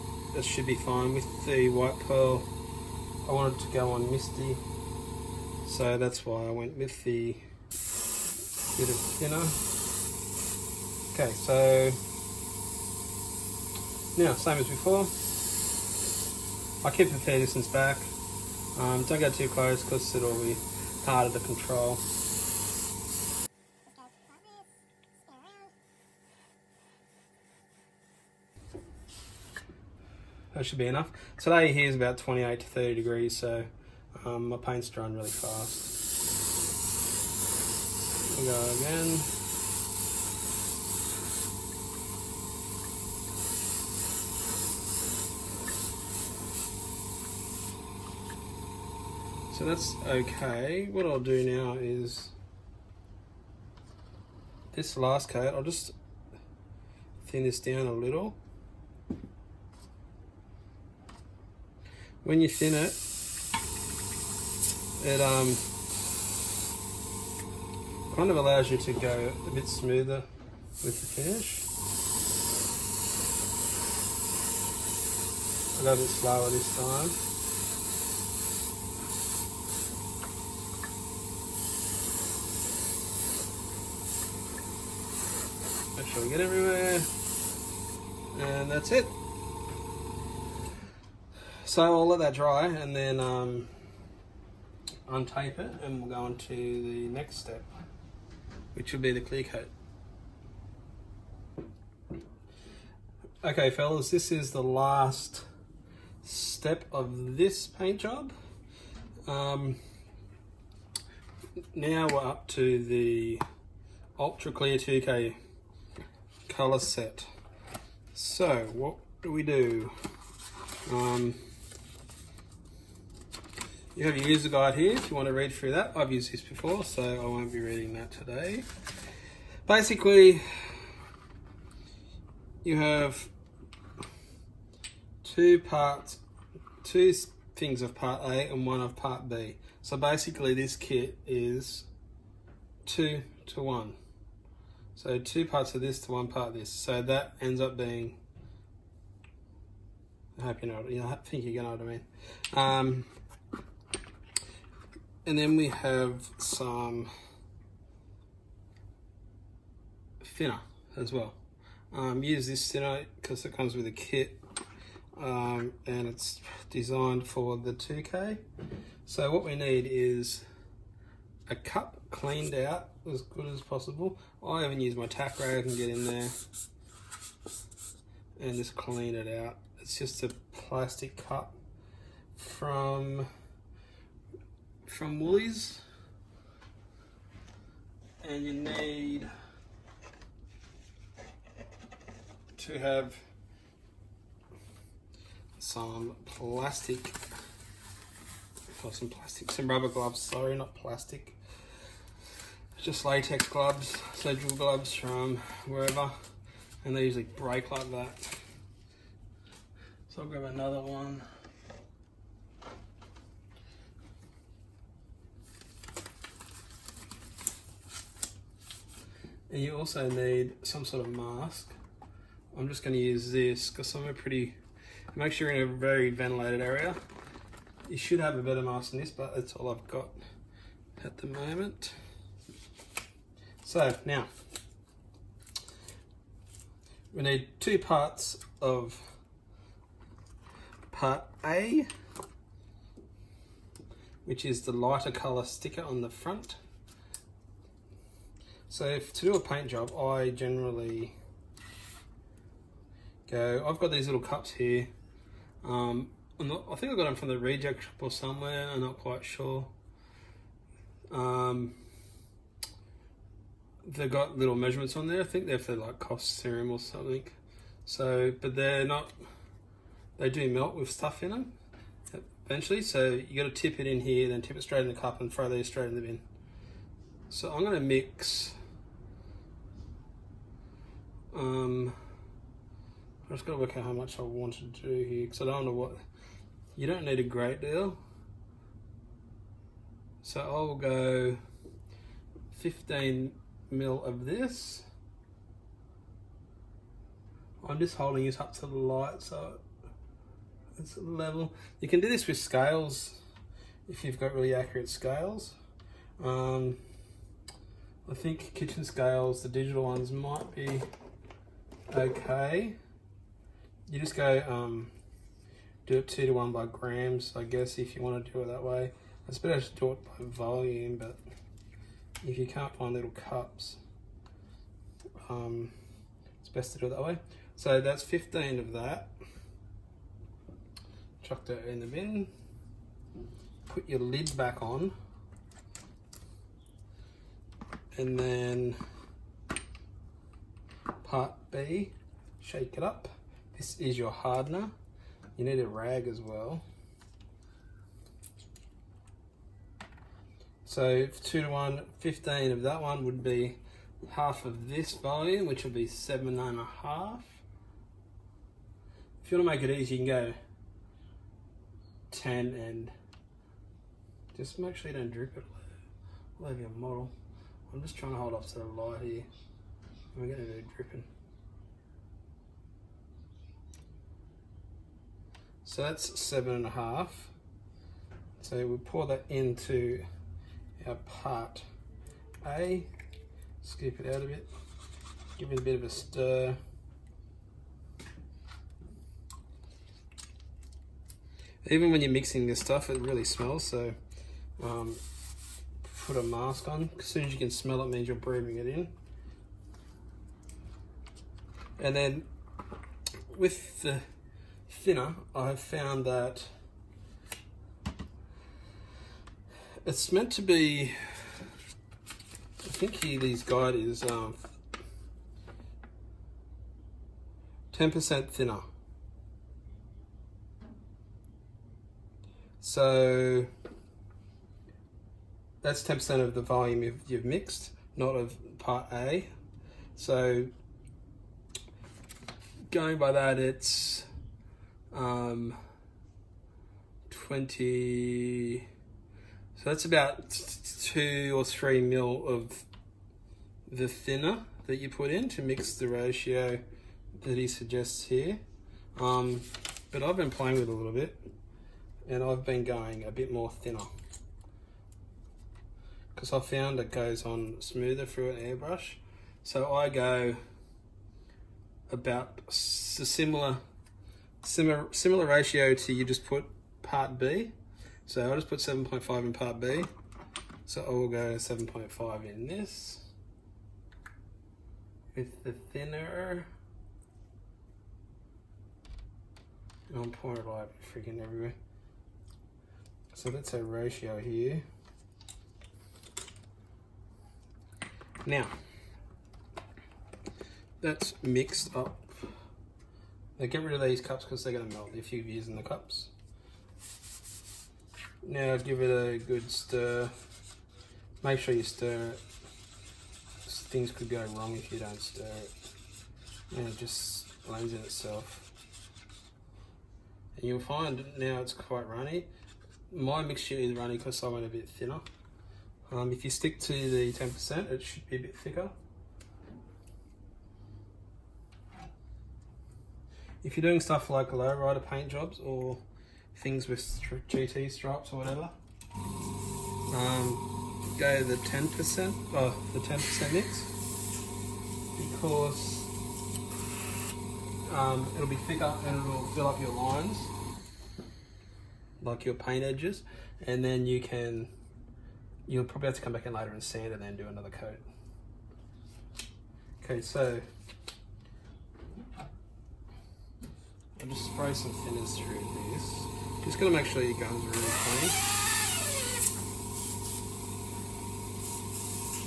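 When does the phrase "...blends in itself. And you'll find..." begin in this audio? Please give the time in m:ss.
8:27.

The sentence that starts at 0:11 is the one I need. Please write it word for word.
Okay, so now same as before.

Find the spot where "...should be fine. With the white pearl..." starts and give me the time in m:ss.
0:00.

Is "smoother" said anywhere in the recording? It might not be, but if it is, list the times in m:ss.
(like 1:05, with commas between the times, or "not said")
1:09, 7:37.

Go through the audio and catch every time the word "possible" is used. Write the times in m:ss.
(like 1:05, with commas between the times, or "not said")
2:53.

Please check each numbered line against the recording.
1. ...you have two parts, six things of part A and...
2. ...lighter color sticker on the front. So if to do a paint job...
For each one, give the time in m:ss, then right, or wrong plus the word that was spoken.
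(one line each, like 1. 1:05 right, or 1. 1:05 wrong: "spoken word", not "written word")
1. 2:12 wrong: "two", not "six"
2. 4:04 right.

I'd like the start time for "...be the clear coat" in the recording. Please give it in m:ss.
1:39.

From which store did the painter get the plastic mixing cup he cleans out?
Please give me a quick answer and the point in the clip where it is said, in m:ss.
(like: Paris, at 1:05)
Woolies, at 3:05.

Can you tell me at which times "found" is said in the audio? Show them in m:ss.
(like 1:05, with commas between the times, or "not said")
6:45, 7:36.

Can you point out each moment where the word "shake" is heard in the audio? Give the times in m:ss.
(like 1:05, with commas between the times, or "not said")
5:42.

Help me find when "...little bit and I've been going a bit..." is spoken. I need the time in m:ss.
7:30.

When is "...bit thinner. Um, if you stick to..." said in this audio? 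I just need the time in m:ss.
8:34.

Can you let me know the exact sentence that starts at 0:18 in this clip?
Um, don't go too close because it'll be harder to control.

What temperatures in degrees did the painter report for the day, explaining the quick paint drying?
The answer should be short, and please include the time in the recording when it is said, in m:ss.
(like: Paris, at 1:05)
28 to 30, at 0:32.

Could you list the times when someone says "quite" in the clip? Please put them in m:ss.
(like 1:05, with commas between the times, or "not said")
4:18, 8:31.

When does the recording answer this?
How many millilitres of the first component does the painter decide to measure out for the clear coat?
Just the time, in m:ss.
4:52.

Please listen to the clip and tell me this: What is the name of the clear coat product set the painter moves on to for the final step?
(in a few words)
Ultra Clear 2K.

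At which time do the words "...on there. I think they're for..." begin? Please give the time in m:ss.
4:24.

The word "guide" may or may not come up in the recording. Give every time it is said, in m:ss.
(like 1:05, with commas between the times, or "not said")
2:04, 6:53.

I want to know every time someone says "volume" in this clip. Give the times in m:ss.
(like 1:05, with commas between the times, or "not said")
5:20, 5:54, 7:06.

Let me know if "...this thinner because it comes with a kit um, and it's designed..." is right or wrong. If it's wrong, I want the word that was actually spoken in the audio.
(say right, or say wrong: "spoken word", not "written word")
right.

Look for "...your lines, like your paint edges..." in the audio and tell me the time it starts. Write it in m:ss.
8:59.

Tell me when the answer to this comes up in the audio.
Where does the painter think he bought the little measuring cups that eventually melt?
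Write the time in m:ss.
4:17.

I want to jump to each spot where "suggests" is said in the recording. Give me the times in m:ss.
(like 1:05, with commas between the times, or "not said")
7:27.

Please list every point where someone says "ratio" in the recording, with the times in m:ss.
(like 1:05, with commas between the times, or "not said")
7:25, 7:45, 8:03.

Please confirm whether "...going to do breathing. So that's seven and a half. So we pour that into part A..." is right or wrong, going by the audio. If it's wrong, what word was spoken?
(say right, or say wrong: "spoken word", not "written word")
wrong: "dripping", not "breathing".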